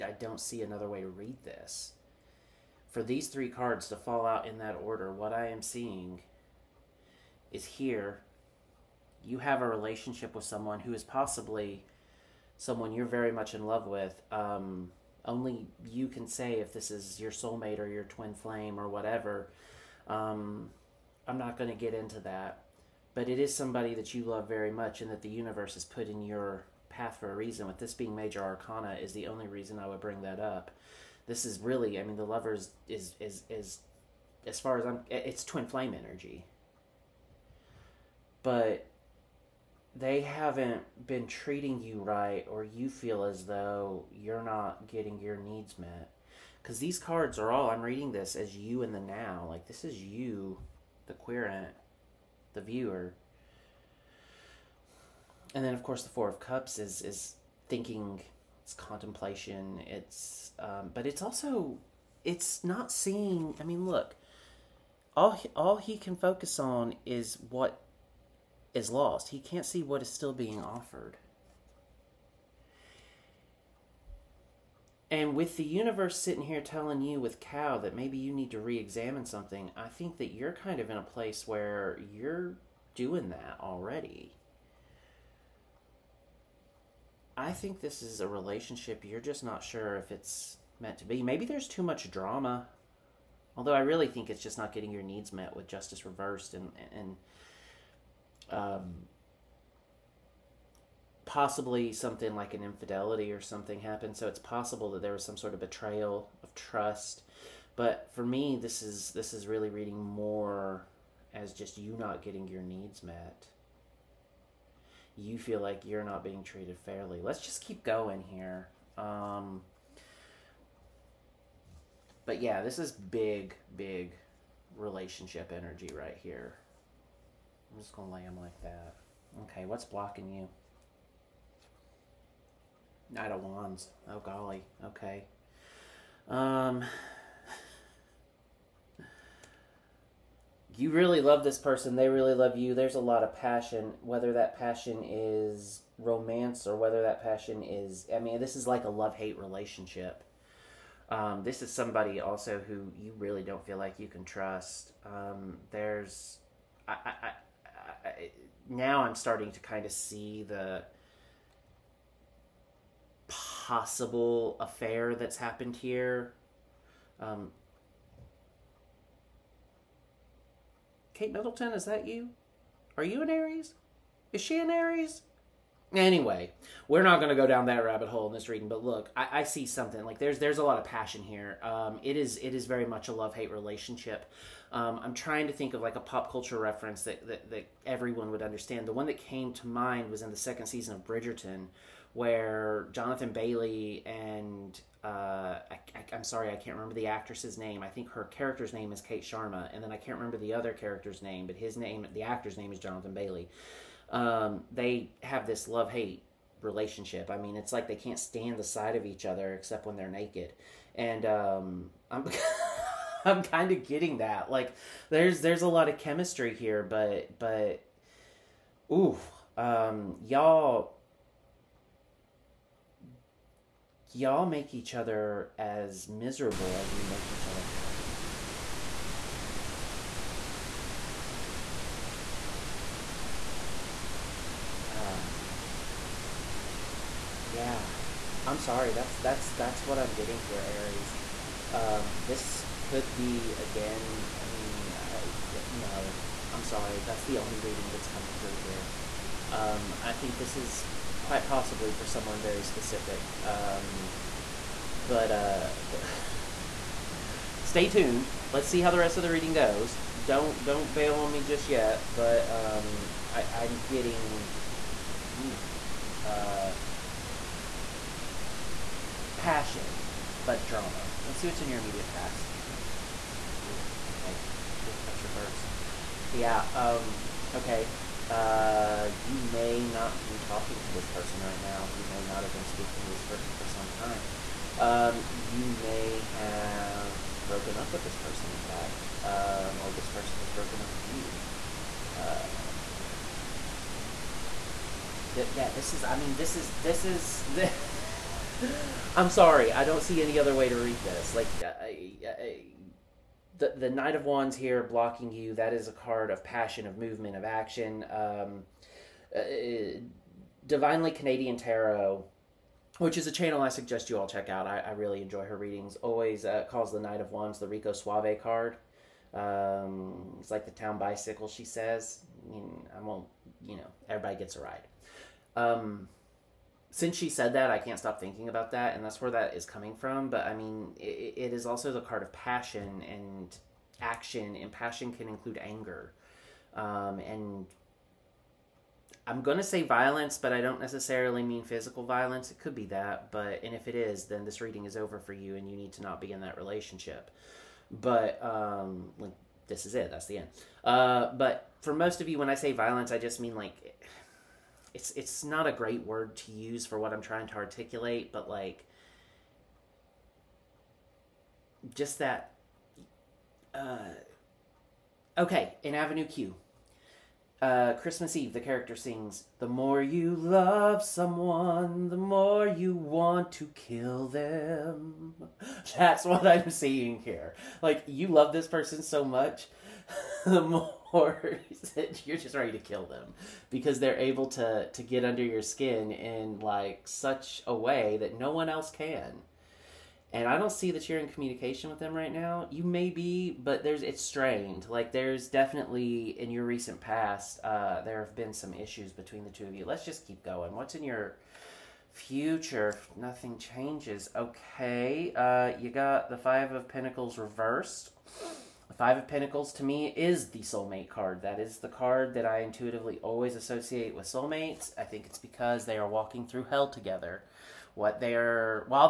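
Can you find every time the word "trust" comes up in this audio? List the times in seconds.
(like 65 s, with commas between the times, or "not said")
106 s, 154 s.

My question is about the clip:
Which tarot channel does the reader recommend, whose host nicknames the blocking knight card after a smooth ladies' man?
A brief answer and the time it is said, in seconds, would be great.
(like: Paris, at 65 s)
Divinely Canadian Tarot, at 310 s.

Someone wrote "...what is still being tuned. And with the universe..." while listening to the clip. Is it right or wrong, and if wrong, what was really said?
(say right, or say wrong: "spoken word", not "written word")
wrong: "offered", not "tuned".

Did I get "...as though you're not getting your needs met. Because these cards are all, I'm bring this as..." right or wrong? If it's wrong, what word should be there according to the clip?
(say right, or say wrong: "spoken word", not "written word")
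wrong: "reading", not "bring".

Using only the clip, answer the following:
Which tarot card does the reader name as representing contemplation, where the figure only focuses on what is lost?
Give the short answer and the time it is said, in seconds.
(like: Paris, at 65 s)
Four of Cups, at 56 s.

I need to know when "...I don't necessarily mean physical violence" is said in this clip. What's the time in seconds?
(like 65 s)
340 s.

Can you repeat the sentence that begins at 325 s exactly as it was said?
Um, since she said that, I can't stop thinking about that, and that's where that is coming from.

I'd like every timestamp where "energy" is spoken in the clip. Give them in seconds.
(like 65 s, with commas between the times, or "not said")
35 s, 125 s.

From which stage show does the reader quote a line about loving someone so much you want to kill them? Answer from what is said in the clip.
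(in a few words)
Avenue Q.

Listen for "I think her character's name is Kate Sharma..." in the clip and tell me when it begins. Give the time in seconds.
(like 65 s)
197 s.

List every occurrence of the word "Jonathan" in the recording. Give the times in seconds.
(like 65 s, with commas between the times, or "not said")
192 s, 202 s.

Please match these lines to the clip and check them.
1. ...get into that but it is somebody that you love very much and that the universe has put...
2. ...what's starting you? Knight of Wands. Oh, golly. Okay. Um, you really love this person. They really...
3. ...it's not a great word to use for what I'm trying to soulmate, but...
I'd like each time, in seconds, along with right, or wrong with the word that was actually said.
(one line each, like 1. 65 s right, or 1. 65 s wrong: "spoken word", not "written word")
1. 21 s right
2. 129 s wrong: "blocking", not "starting"
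3. 355 s wrong: "articulate", not "soulmate".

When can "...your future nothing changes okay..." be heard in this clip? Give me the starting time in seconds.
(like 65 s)
401 s.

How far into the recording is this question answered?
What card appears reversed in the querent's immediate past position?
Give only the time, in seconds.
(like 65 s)
274 s.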